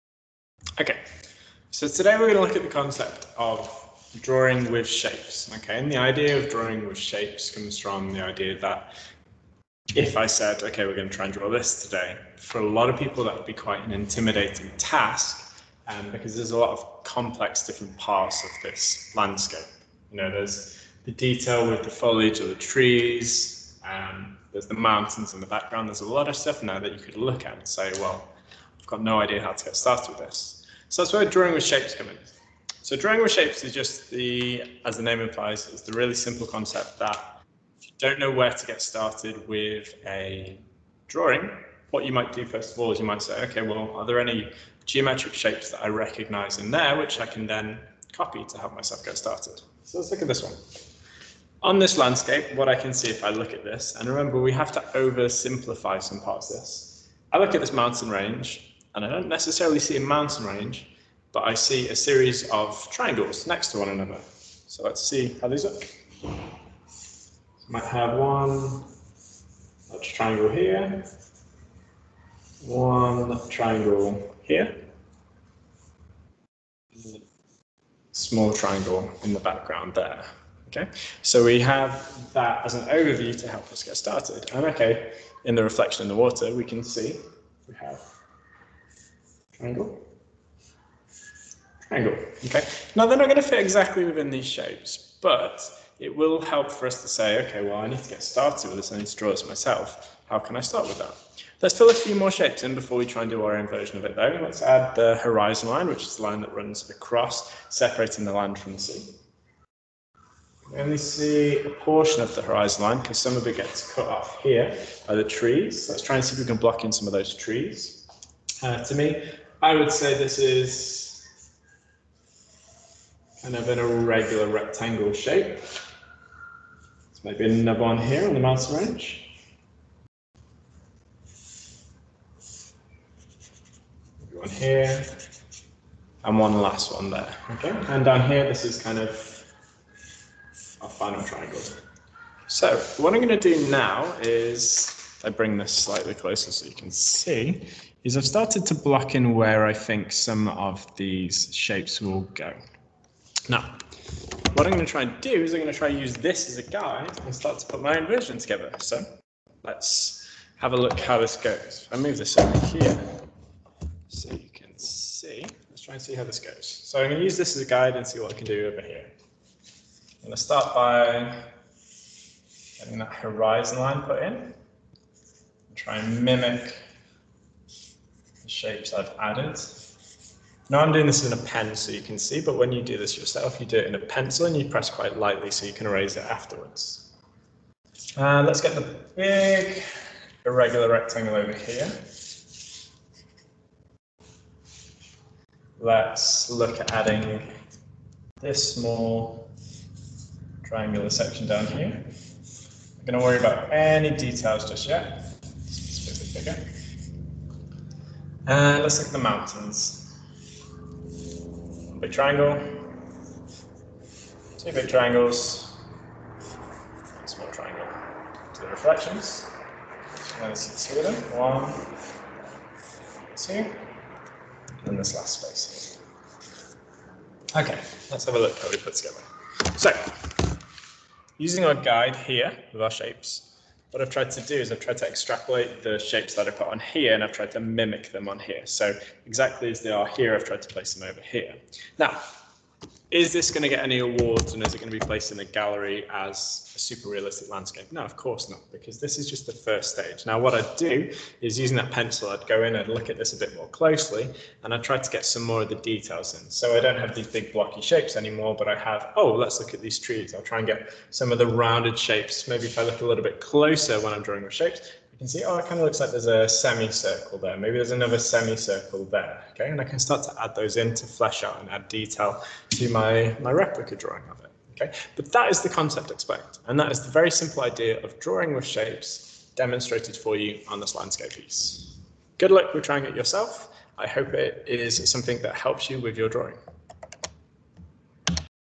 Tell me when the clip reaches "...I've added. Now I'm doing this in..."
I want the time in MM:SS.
02:58.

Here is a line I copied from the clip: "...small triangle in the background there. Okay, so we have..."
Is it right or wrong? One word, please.
right.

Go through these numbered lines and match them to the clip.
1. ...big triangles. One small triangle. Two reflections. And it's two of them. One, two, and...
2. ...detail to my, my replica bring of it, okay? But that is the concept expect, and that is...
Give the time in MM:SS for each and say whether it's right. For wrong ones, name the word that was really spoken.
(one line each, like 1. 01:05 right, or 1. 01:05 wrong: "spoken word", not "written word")
1. 03:34 right
2. 04:31 wrong: "drawing", not "bring".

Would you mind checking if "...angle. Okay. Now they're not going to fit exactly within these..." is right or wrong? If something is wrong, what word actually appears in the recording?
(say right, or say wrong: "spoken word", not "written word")
right.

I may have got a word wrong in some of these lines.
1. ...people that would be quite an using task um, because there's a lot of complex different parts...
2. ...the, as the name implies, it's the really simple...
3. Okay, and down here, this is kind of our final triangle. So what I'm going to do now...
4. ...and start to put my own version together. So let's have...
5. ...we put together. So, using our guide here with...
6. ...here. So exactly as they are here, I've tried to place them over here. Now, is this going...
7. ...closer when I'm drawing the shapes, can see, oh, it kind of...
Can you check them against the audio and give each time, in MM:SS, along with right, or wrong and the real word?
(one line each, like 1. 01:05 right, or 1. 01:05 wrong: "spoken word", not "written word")
1. 00:12 wrong: "intimidating", not "using"
2. 00:34 right
3. 02:17 right
4. 02:37 right
5. 03:48 right
6. 03:58 right
7. 04:23 right.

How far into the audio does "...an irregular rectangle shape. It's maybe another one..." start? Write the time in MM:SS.
02:03.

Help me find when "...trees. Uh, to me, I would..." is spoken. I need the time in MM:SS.
01:57.